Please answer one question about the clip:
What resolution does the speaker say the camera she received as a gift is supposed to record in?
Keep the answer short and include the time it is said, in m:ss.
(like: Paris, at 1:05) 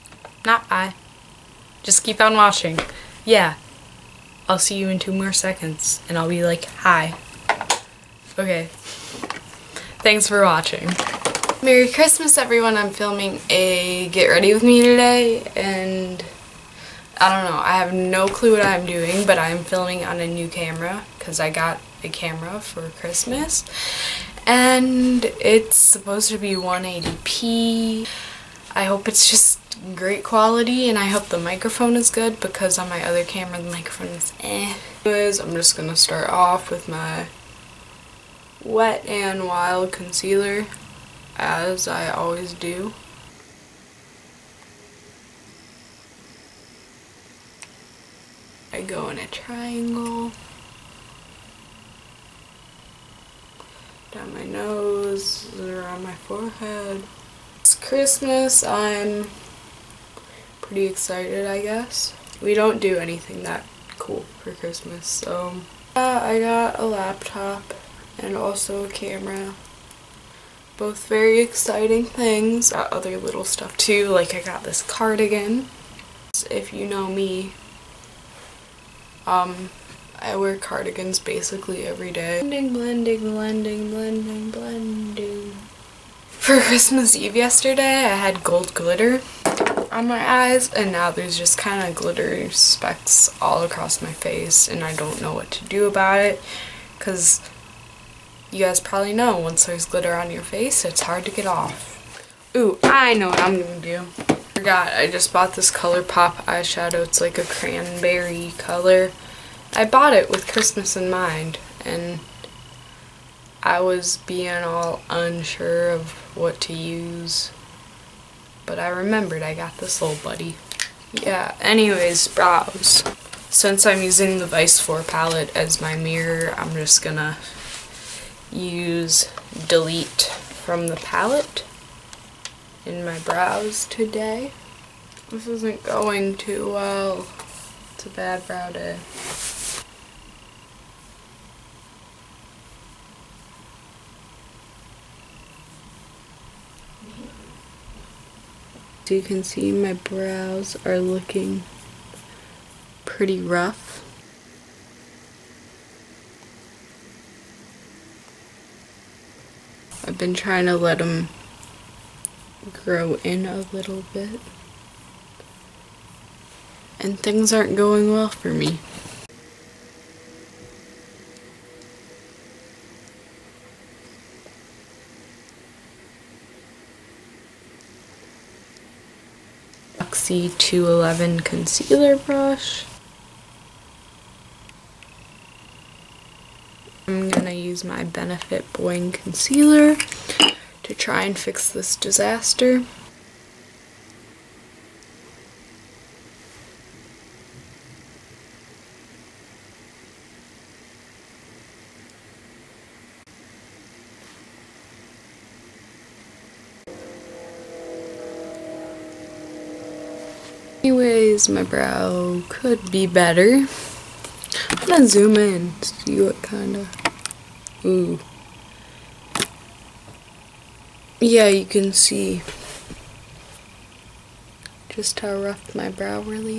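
180p, at 0:26.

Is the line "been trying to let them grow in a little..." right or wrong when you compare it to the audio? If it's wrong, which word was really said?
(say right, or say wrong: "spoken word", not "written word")
right.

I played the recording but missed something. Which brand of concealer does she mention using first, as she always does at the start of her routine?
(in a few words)
Wet n Wild.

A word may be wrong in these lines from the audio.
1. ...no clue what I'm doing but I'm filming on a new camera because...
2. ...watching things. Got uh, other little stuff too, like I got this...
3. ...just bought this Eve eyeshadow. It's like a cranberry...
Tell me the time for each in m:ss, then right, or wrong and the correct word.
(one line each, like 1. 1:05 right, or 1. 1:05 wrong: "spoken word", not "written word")
1. 0:17 right
2. 1:11 wrong: "exciting", not "watching"
3. 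1:45 wrong: "ColourPop", not "Eve".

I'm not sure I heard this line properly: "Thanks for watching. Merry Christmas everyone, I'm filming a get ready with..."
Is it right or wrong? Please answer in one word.
right.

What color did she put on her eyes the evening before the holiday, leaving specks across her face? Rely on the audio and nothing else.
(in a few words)
gold glitter.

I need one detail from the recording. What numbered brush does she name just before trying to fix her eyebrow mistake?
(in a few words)
Luxie 211.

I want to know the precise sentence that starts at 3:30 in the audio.
Anyways, my brow could be better.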